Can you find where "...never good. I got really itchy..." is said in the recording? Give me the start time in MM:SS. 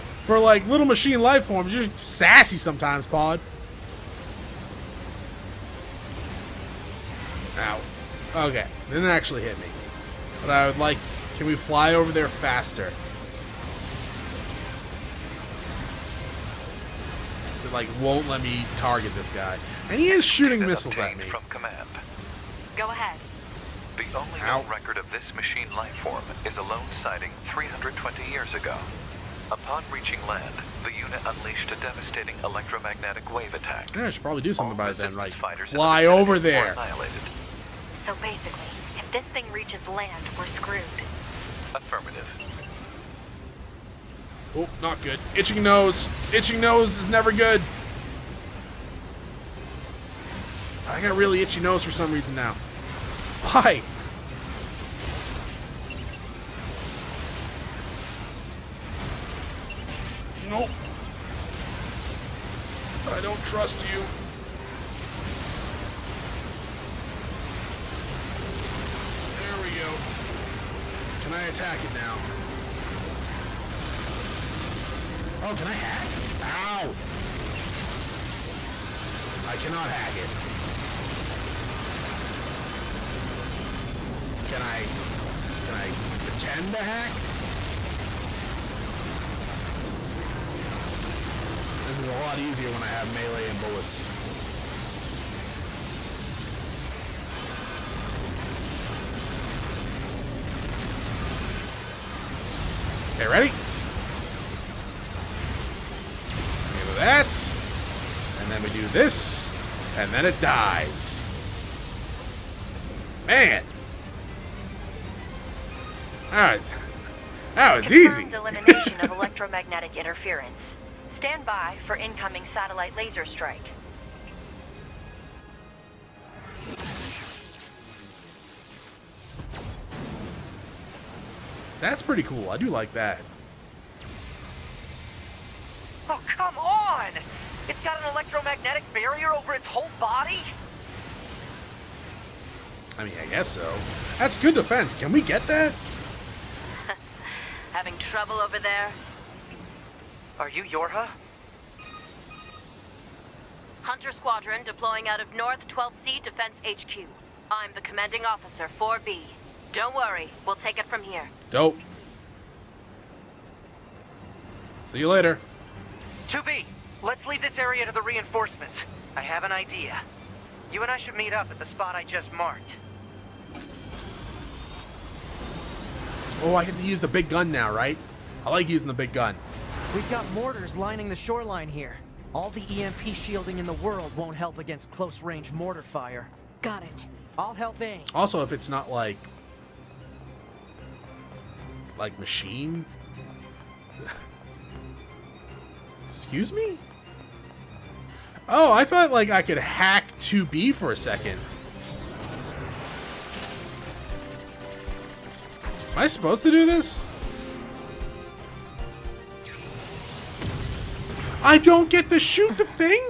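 00:47.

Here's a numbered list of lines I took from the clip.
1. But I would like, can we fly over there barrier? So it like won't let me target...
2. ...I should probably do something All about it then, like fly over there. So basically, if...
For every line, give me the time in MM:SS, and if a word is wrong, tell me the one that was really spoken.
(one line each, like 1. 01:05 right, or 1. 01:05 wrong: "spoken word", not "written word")
1. 00:10 wrong: "faster", not "barrier"
2. 00:34 right.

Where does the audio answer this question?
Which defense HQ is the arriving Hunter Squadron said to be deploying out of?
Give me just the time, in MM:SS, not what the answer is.
02:35.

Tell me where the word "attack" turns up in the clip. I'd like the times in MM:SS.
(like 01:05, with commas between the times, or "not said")
00:33, 01:11.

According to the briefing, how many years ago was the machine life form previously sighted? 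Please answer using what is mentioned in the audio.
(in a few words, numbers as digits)
320.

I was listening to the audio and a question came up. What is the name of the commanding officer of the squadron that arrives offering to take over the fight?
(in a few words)
4B.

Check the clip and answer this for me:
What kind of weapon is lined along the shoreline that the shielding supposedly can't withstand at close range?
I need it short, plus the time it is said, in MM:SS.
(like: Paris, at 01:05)
Mortars, at 03:00.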